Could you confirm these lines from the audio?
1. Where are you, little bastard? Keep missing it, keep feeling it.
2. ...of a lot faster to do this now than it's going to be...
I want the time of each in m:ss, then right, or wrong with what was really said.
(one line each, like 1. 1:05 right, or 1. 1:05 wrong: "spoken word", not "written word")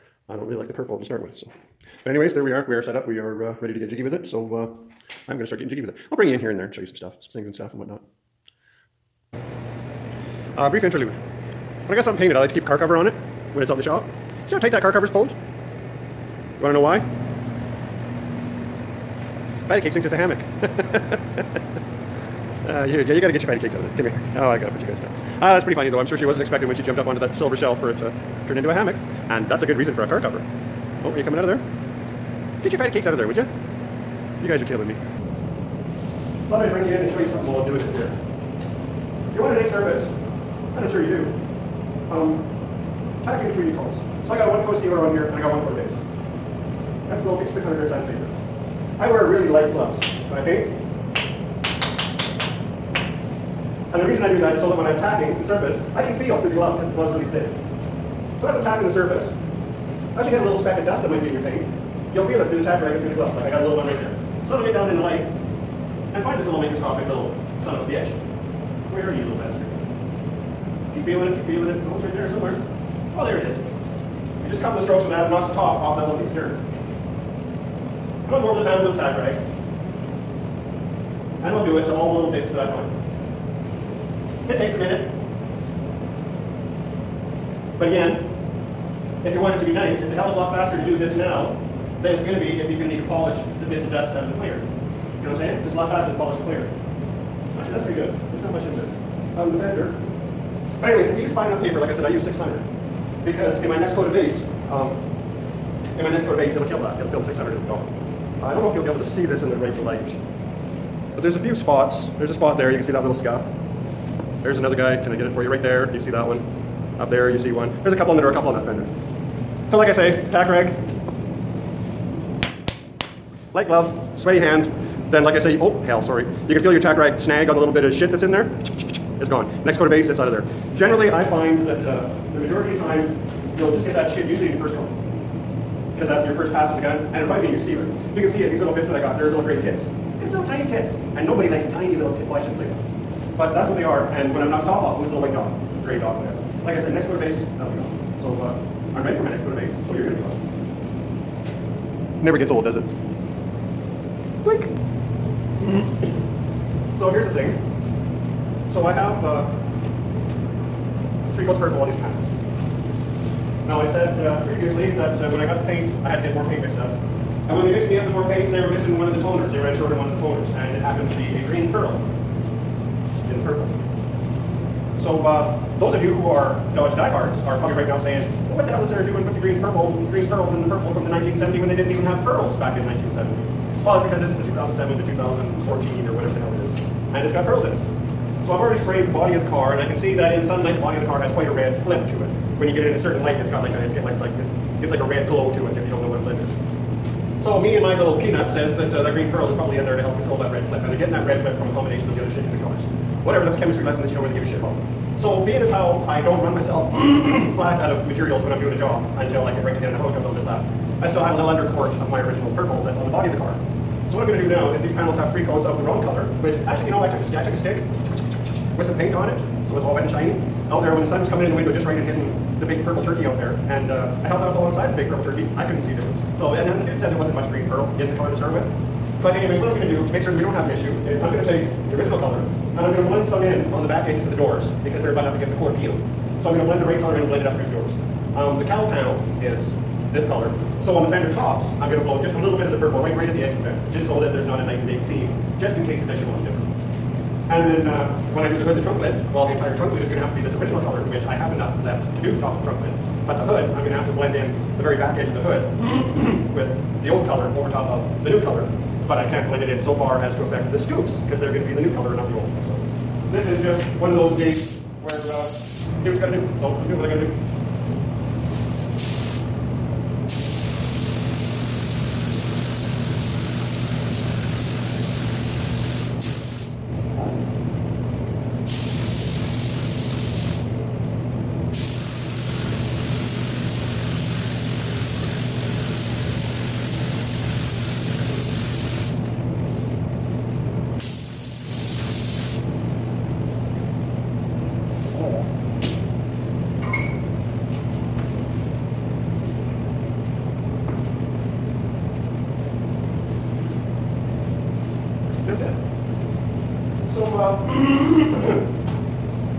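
1. 1:08 wrong: "feeling", not "missing"
2. 1:30 right.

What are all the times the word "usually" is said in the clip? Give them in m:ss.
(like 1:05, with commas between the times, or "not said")
2:14.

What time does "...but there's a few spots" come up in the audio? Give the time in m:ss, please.
1:51.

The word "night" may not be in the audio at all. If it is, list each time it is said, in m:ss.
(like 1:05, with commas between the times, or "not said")
4:04.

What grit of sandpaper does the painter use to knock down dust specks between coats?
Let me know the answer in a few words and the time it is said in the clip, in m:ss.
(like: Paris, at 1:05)
600, at 0:47.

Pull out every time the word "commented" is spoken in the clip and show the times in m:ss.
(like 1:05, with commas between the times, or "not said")
not said.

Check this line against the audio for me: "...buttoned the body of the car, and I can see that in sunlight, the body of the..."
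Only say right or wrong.
wrong.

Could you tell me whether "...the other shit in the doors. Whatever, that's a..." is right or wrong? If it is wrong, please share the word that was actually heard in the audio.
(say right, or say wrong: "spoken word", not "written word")
wrong: "colors", not "doors".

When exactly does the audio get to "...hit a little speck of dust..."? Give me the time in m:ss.
1:00.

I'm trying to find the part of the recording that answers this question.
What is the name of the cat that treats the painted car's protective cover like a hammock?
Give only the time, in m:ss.
0:19.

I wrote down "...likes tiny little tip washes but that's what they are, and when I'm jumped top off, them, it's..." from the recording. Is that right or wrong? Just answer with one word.
wrong.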